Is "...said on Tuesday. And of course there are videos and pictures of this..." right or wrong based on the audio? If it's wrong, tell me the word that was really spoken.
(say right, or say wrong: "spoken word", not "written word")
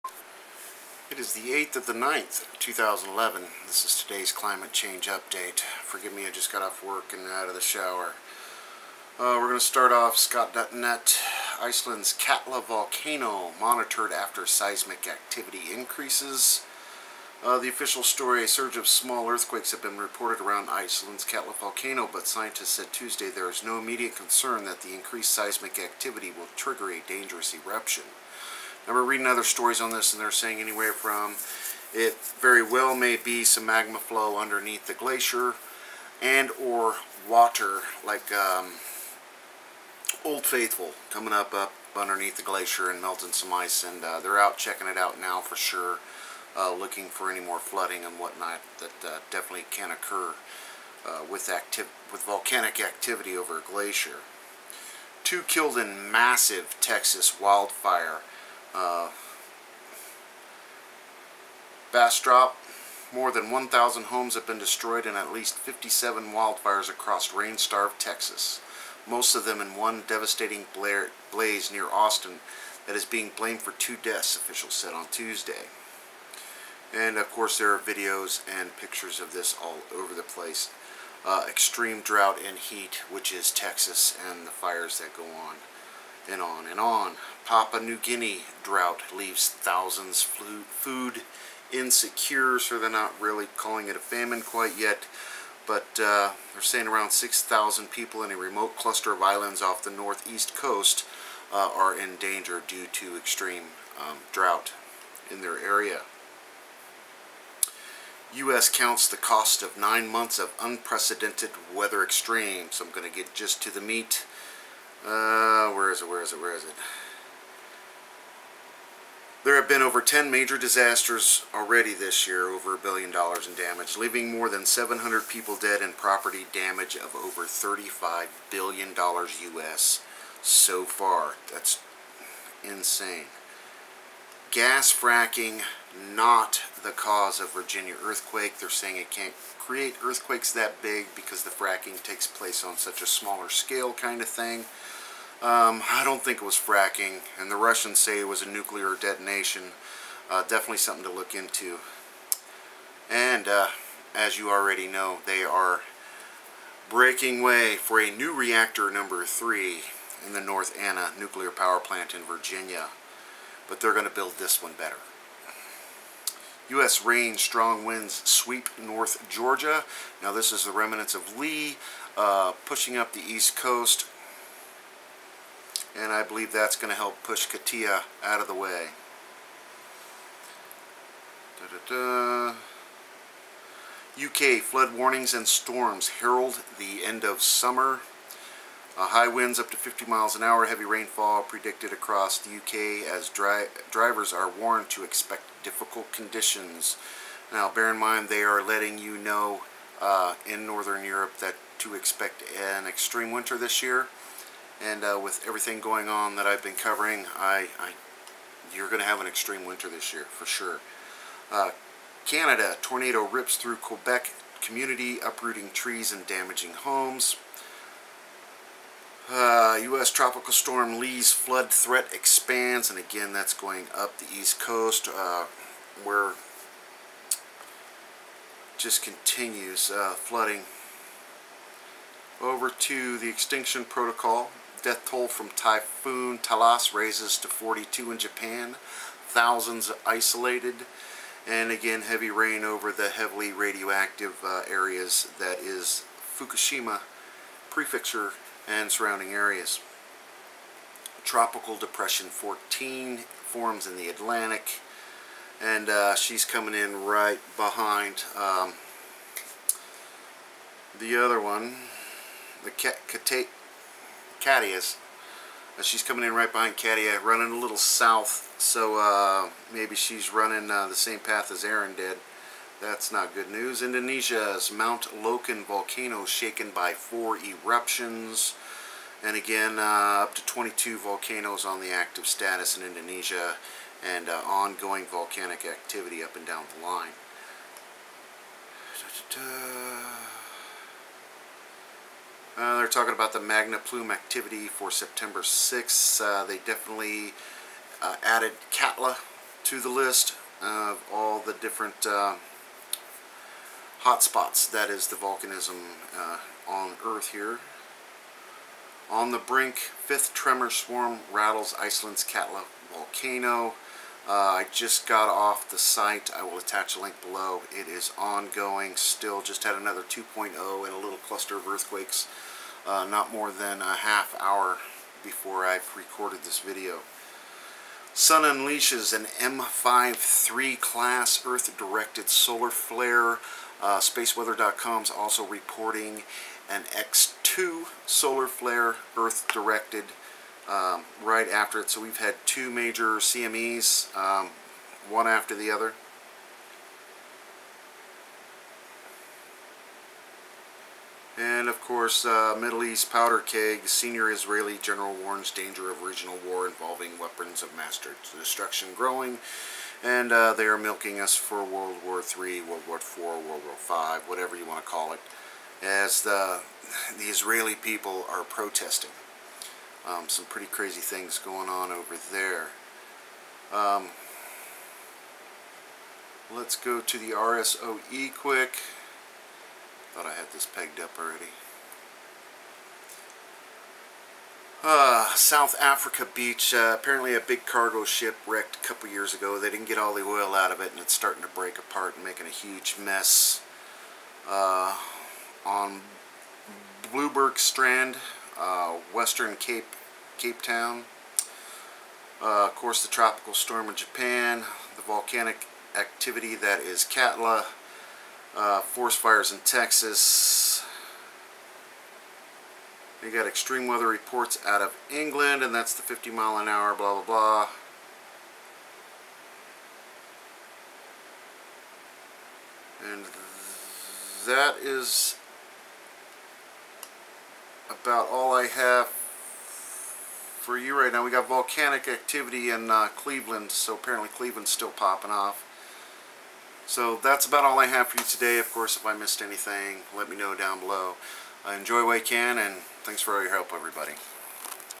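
right.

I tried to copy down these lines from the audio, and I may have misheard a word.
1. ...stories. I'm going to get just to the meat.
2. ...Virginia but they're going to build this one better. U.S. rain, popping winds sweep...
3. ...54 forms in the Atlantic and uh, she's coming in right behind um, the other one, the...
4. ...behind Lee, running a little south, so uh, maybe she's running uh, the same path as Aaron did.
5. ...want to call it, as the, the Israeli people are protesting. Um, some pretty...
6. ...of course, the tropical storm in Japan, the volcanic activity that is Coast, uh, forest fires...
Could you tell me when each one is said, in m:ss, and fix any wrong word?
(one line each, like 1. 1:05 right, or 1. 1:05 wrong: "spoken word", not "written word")
1. 1:52 wrong: "extremes", not "stories"
2. 2:42 wrong: "strong", not "popping"
3. 4:12 wrong: "14", not "54"
4. 4:26 wrong: "Katia", not "Lee"
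5. 6:04 right
6. 6:42 wrong: "Katla", not "Coast".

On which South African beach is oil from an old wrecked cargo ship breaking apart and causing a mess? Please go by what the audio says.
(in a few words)
Blouberg Strand.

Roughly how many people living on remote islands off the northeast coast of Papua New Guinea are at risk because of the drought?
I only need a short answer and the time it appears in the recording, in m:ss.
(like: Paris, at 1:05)
6,000, at 1:37.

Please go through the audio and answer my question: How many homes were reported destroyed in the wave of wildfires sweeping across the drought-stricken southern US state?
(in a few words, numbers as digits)
more than 1,000.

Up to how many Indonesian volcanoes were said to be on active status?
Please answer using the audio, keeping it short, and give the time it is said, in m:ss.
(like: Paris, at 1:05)
22, at 4:40.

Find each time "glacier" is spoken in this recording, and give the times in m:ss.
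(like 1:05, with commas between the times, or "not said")
0:34, 0:42, 0:53.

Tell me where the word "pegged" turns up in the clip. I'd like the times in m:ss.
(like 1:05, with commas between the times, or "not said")
6:20.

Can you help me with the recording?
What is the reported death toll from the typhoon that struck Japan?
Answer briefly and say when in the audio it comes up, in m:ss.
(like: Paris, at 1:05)
42, at 3:57.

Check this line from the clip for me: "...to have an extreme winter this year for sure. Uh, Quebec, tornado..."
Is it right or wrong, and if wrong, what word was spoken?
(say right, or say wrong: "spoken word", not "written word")
wrong: "Canada", not "Quebec".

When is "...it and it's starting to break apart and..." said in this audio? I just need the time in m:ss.
6:30.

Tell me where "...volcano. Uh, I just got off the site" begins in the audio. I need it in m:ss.
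5:12.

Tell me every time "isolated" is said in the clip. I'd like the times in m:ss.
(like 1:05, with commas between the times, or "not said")
4:00.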